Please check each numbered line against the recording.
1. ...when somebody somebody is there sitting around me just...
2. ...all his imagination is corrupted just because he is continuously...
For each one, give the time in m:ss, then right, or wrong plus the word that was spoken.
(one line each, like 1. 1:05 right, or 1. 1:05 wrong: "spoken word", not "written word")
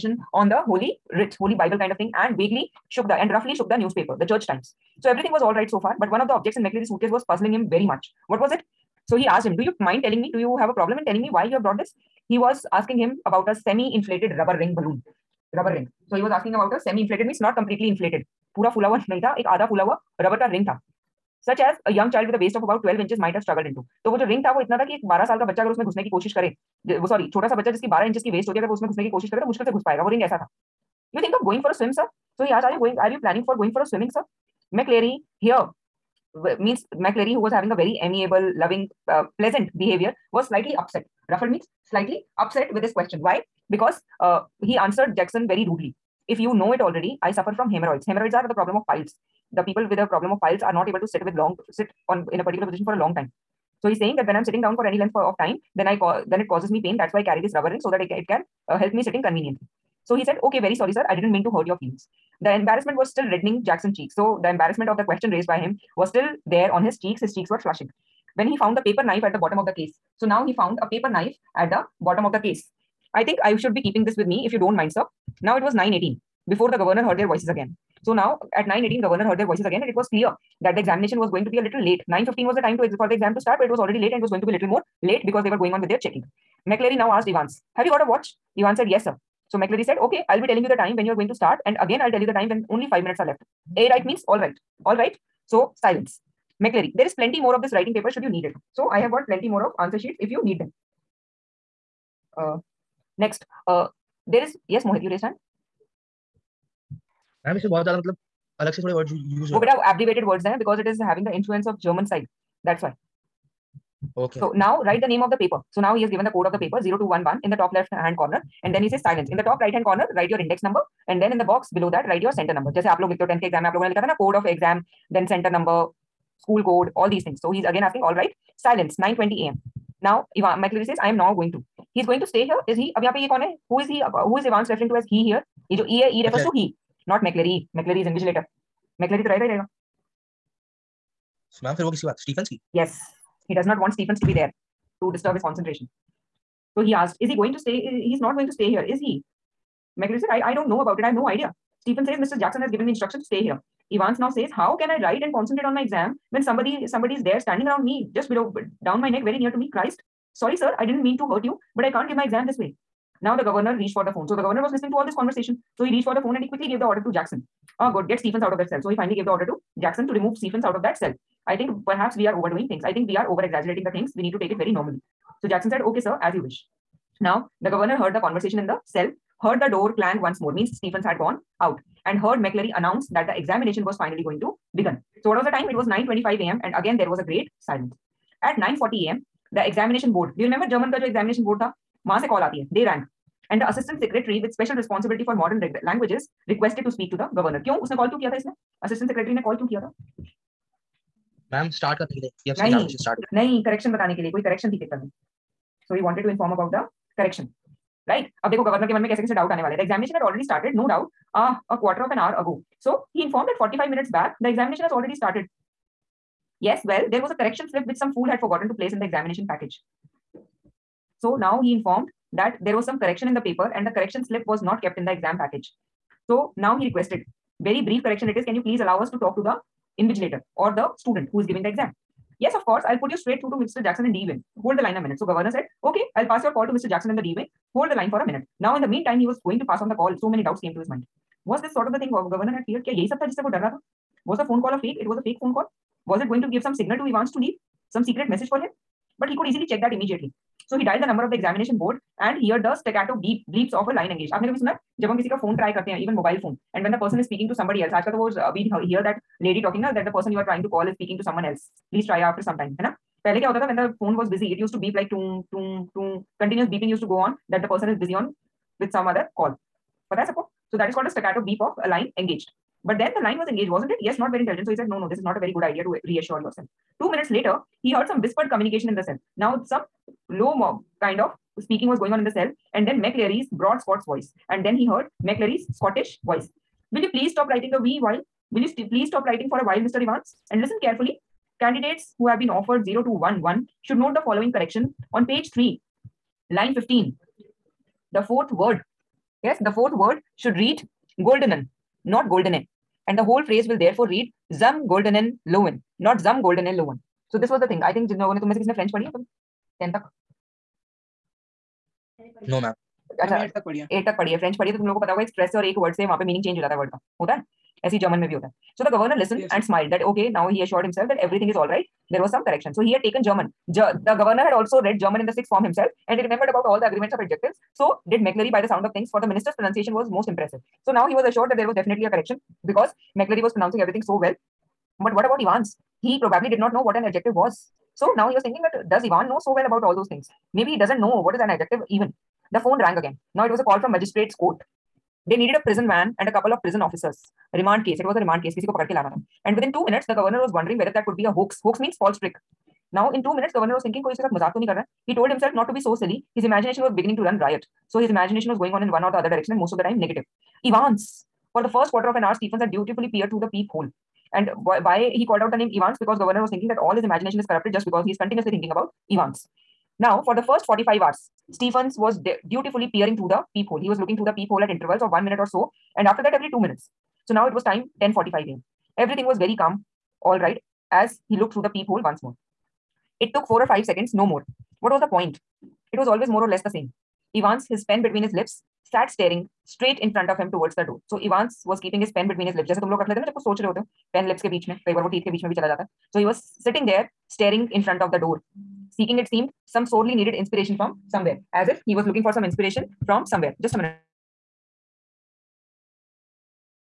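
1. 2:36 wrong: "standing", not "sitting"
2. 6:06 right.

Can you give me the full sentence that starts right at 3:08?
At 9.40 a.m., the examination board, do you remember German ka jo examination board tha?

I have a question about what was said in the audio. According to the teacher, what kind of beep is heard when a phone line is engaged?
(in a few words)
staccato beep.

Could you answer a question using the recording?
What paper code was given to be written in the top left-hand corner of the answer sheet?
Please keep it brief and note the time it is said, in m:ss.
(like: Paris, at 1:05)
0211, at 1:56.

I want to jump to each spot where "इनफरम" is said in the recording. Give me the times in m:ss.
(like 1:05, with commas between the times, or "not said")
3:26, 3:33.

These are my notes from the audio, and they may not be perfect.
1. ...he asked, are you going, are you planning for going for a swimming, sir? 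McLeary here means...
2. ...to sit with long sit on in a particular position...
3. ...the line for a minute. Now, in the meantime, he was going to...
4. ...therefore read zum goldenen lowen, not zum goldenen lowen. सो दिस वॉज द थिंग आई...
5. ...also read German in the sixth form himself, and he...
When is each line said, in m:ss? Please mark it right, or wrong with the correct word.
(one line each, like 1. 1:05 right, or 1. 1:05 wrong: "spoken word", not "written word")
1. 0:32 right
2. 0:50 right
3. 3:57 right
4. 5:03 right
5. 5:24 right.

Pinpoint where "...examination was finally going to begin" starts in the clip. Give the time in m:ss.
3:03.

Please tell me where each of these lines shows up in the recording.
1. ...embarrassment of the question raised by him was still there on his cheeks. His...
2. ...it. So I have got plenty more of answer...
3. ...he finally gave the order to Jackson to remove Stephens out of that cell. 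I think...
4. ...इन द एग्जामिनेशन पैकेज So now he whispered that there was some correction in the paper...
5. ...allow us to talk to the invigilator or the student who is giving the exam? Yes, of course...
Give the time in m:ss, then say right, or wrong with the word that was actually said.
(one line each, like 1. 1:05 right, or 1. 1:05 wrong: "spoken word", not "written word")
1. 1:04 right
2. 1:38 right
3. 2:48 right
4. 3:38 wrong: "informed", not "whispered"
5. 3:48 right.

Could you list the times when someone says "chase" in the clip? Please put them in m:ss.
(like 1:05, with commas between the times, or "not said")
not said.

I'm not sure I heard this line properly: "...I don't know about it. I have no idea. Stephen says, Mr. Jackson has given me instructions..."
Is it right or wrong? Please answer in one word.
right.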